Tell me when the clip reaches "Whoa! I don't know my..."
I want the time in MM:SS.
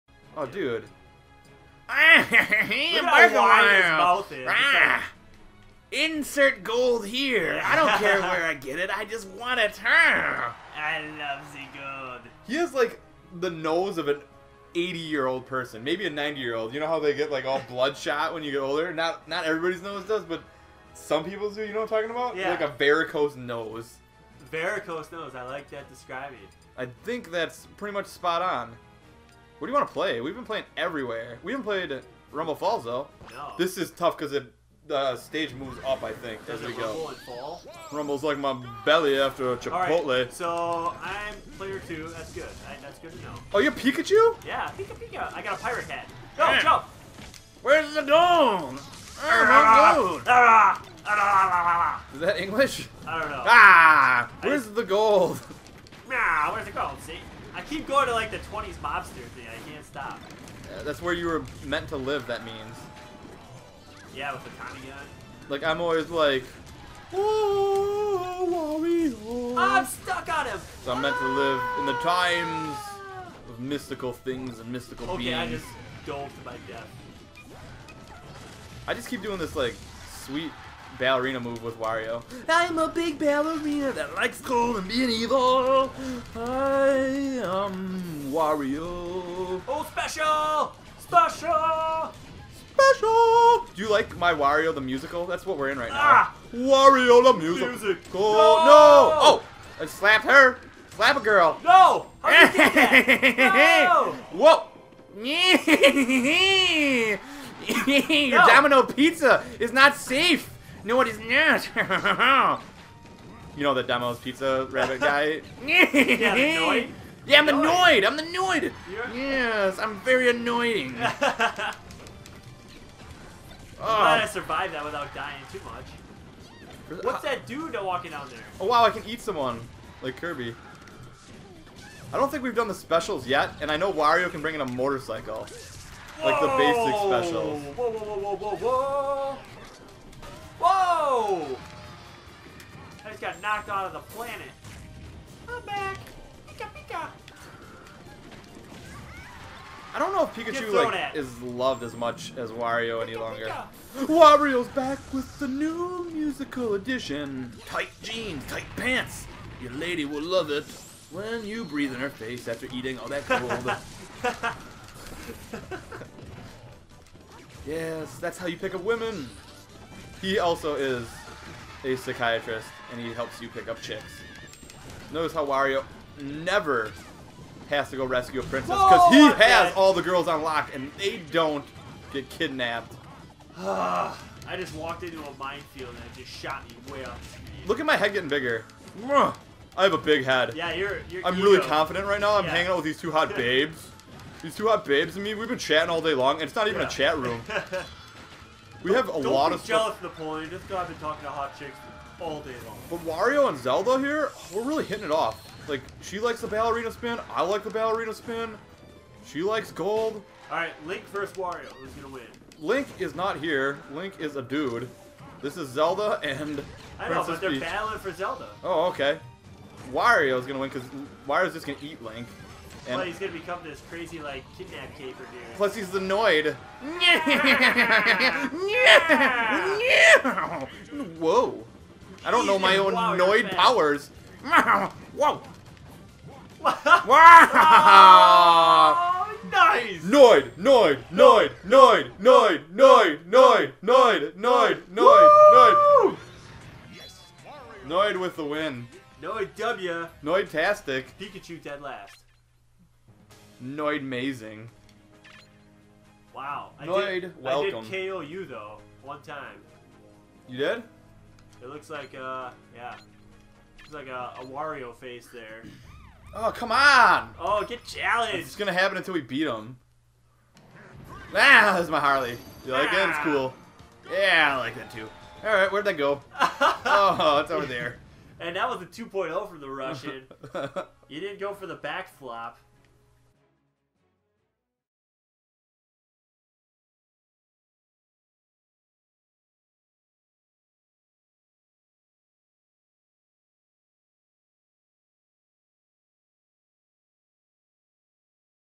03:51.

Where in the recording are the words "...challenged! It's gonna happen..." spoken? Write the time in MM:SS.
04:27.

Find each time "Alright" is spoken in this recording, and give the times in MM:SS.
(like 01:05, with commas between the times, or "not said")
00:40.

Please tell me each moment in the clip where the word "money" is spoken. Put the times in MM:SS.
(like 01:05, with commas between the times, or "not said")
not said.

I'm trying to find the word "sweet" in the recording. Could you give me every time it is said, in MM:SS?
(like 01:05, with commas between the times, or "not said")
01:20.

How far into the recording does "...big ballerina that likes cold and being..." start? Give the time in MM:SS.
01:22.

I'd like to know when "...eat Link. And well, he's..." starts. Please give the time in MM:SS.
03:41.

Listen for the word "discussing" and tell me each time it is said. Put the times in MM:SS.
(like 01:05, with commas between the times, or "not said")
not said.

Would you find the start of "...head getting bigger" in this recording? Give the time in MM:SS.
03:07.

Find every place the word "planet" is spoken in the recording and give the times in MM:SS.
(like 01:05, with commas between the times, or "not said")
02:24.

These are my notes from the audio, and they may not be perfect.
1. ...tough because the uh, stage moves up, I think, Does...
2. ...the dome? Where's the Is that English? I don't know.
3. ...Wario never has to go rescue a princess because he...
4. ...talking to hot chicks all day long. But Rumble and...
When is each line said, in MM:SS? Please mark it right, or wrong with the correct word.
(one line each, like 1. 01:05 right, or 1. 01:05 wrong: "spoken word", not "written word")
1. 00:33 right
2. 00:47 right
3. 02:55 right
4. 03:20 wrong: "Wario", not "Rumble".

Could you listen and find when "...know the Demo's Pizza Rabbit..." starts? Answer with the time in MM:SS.
01:53.